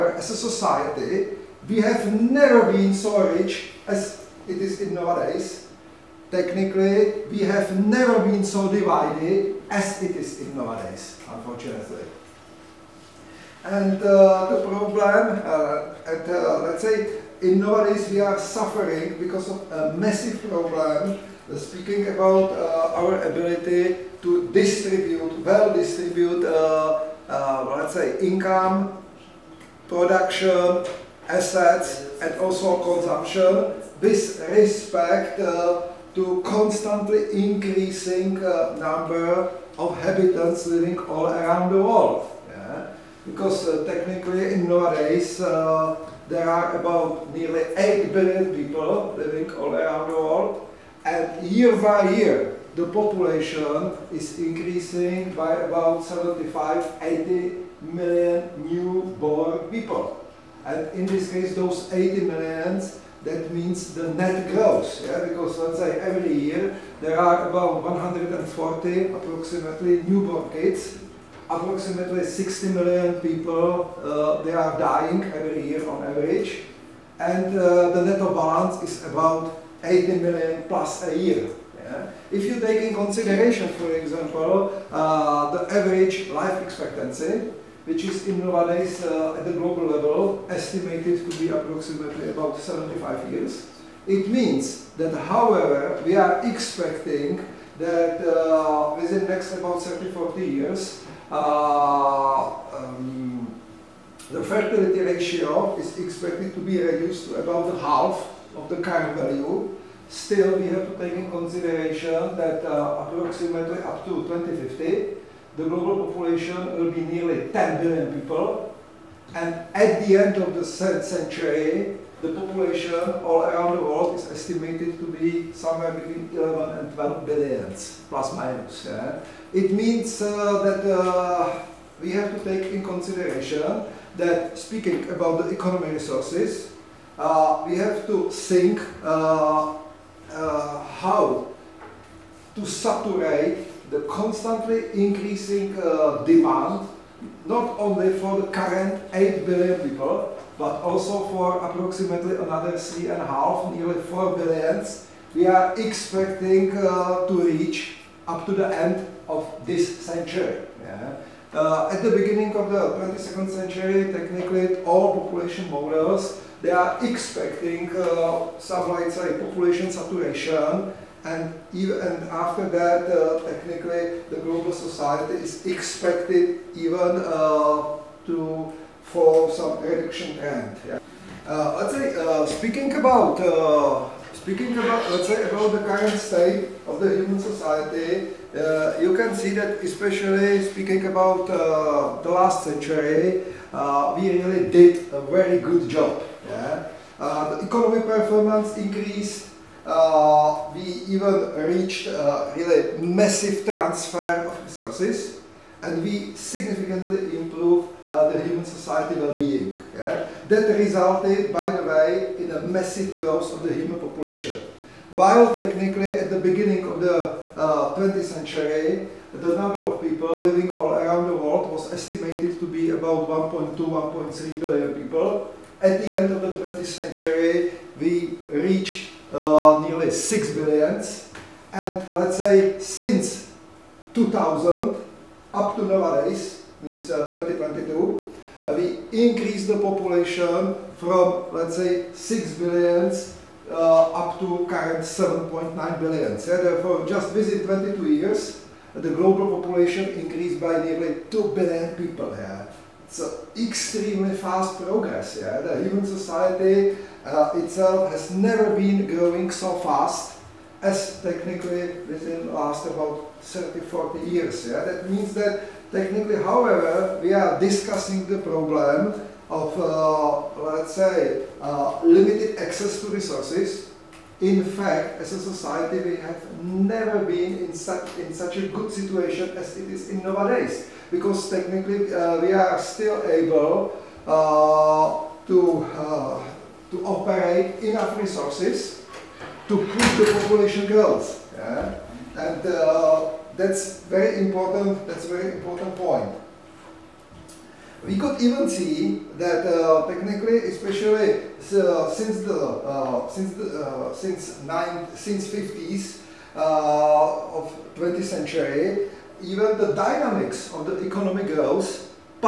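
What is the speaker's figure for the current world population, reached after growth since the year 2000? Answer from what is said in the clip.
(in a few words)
7.9 billion.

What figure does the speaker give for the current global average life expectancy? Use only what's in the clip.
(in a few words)
75 years.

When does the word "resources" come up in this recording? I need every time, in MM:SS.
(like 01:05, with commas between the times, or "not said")
02:15, 03:24, 04:33, 04:48.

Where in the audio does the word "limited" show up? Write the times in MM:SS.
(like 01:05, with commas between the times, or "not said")
04:32.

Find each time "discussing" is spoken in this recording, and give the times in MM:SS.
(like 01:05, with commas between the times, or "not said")
04:27.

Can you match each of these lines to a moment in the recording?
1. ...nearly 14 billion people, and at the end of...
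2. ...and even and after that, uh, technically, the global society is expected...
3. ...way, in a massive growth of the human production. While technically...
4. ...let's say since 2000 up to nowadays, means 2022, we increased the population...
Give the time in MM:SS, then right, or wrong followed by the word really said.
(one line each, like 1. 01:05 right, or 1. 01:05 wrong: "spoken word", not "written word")
1. 01:57 wrong: "10", not "14"
2. 02:51 right
3. 03:31 wrong: "population", not "production"
4. 03:52 right.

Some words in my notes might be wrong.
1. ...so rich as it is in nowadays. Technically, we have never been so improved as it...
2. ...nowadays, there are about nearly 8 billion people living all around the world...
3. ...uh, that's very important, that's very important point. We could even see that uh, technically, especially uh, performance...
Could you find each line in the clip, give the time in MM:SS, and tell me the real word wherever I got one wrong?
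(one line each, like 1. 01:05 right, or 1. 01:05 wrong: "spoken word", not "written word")
1. 00:02 wrong: "divided", not "improved"
2. 00:44 right
3. 04:52 wrong: "since", not "performance".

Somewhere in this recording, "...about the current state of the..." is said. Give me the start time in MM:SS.
03:05.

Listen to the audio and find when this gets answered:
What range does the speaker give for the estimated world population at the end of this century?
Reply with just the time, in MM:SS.
02:05.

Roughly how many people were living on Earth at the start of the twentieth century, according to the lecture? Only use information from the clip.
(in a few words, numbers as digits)
1.2 to 1.3 billion.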